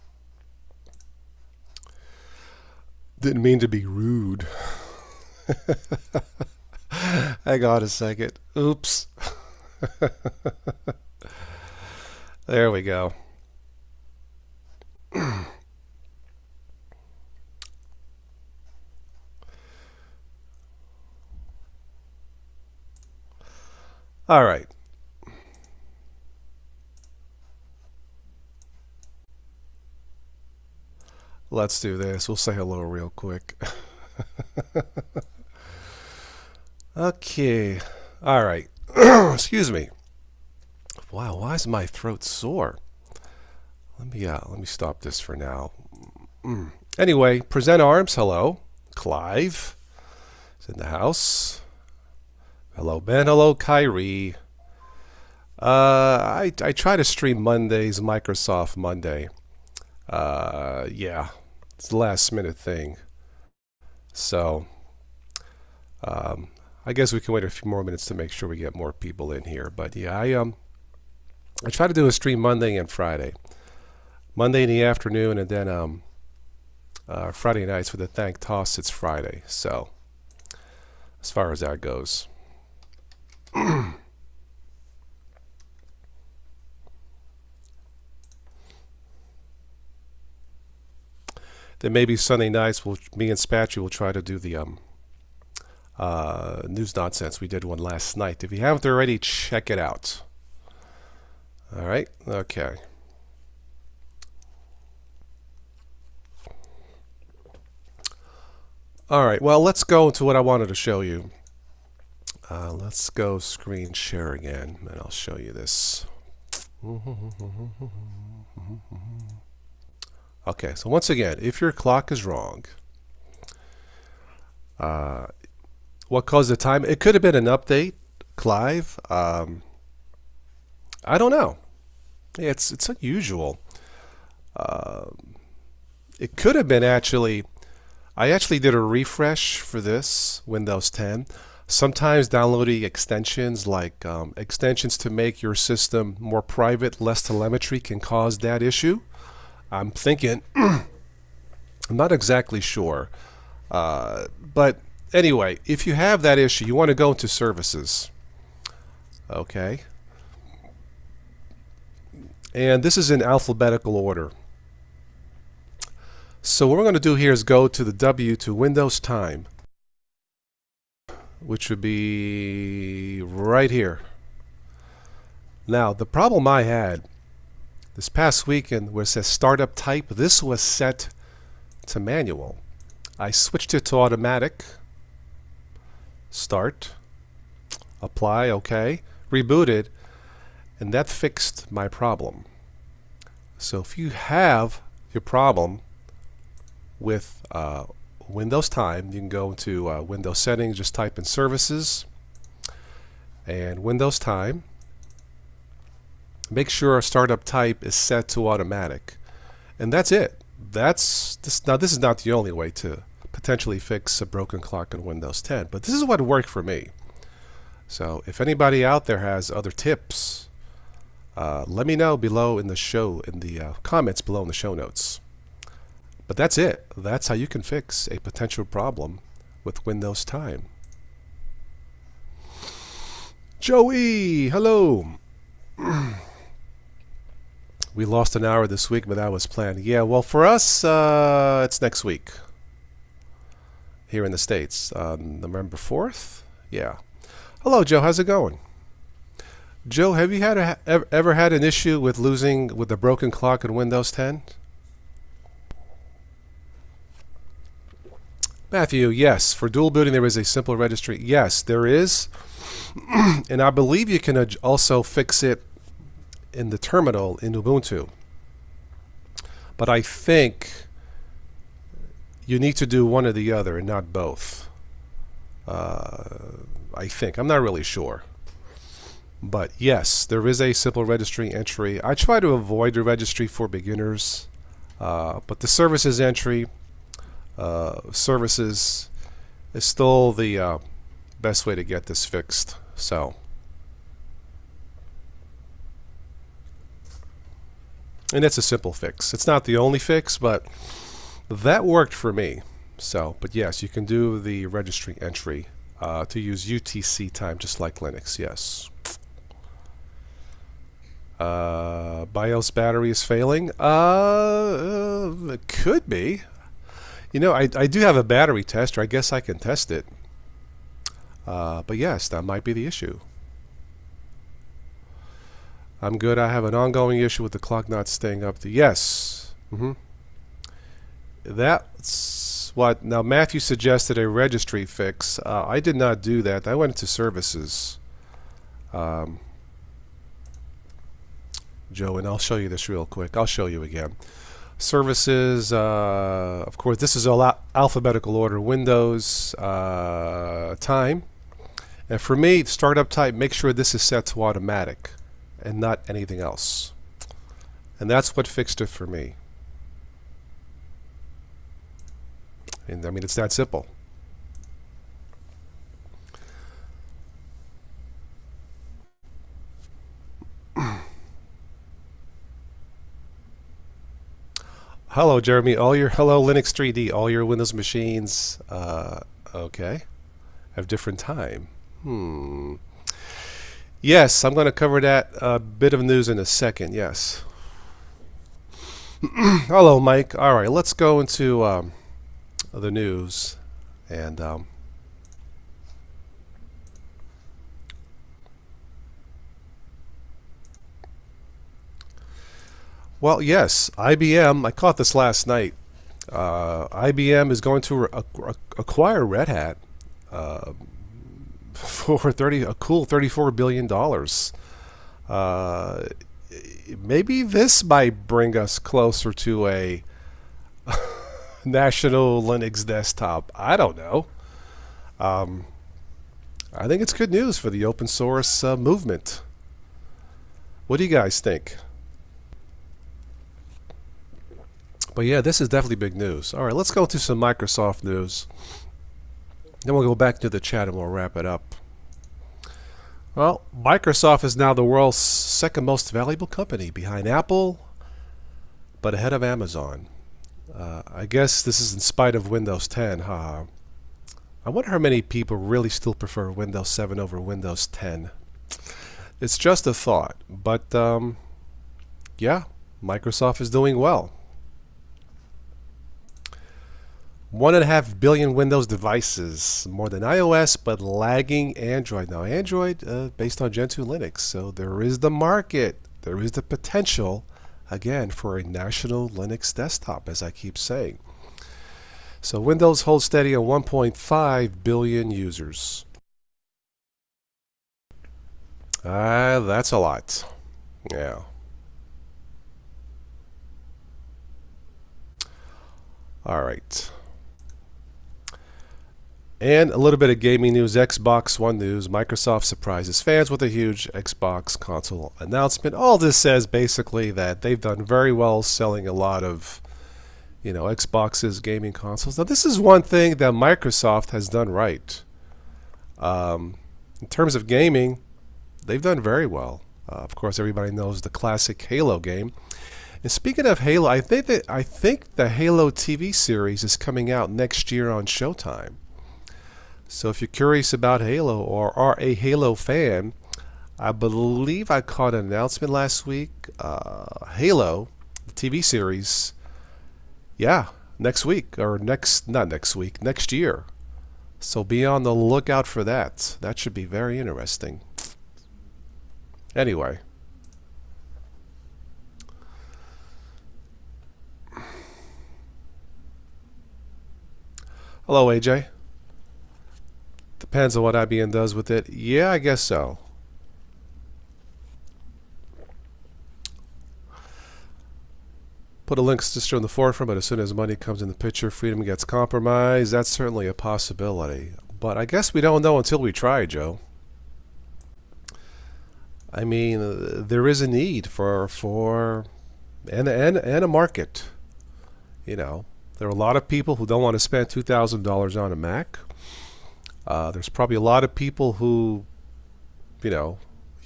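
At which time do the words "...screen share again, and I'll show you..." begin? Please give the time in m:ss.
1:53.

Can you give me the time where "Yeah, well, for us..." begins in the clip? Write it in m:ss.
3:59.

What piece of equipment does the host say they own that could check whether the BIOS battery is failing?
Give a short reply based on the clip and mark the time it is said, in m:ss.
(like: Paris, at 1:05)
battery tester, at 5:18.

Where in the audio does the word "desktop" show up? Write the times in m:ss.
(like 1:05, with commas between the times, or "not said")
7:02, 7:59.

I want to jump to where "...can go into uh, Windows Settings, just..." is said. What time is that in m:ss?
3:19.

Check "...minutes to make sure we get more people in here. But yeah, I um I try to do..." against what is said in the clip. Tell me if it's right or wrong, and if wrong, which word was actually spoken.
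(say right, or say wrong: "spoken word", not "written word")
right.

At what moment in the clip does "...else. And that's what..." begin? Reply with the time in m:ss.
5:56.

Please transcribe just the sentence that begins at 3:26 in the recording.
Make sure our startup type is set to automatic.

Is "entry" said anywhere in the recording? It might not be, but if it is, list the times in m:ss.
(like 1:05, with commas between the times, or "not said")
4:41, 4:46, 5:05.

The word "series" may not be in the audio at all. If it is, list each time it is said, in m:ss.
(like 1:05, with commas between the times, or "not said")
8:46, 8:58.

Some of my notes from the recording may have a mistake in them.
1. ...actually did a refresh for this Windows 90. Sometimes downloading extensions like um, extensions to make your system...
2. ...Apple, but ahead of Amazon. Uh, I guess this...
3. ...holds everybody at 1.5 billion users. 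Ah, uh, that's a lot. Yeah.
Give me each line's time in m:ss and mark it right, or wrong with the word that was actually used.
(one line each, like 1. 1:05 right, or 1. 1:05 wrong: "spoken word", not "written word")
1. 2:18 wrong: "10", not "90"
2. 7:27 right
3. 8:03 wrong: "steady", not "everybody".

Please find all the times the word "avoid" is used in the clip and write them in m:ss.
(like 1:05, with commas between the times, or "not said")
4:42.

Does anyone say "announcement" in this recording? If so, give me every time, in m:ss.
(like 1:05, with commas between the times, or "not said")
8:25, 8:55.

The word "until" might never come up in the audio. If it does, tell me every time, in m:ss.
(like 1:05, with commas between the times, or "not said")
9:35.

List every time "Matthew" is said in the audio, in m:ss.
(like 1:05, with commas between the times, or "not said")
4:18, 5:33.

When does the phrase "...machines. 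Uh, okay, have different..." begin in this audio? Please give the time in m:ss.
6:17.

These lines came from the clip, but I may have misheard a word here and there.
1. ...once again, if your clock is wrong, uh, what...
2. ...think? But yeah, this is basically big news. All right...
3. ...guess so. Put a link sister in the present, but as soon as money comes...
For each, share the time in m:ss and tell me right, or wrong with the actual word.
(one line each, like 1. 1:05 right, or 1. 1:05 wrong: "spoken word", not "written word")
1. 2:00 right
2. 7:11 wrong: "definitely", not "basically"
3. 9:22 wrong: "forefront", not "present".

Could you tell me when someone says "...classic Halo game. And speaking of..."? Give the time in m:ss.
8:41.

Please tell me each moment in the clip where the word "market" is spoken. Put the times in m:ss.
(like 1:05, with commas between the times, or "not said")
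7:55, 9:43.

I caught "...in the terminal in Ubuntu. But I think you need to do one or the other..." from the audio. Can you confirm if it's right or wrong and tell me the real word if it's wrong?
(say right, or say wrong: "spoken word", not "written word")
right.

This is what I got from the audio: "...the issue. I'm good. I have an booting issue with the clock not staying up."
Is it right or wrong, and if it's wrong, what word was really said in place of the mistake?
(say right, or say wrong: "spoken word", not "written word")
wrong: "ongoing", not "booting".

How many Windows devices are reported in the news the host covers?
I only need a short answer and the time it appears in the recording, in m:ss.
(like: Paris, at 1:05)
1.5 billion, at 7:47.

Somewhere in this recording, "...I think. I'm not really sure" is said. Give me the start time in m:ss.
4:36.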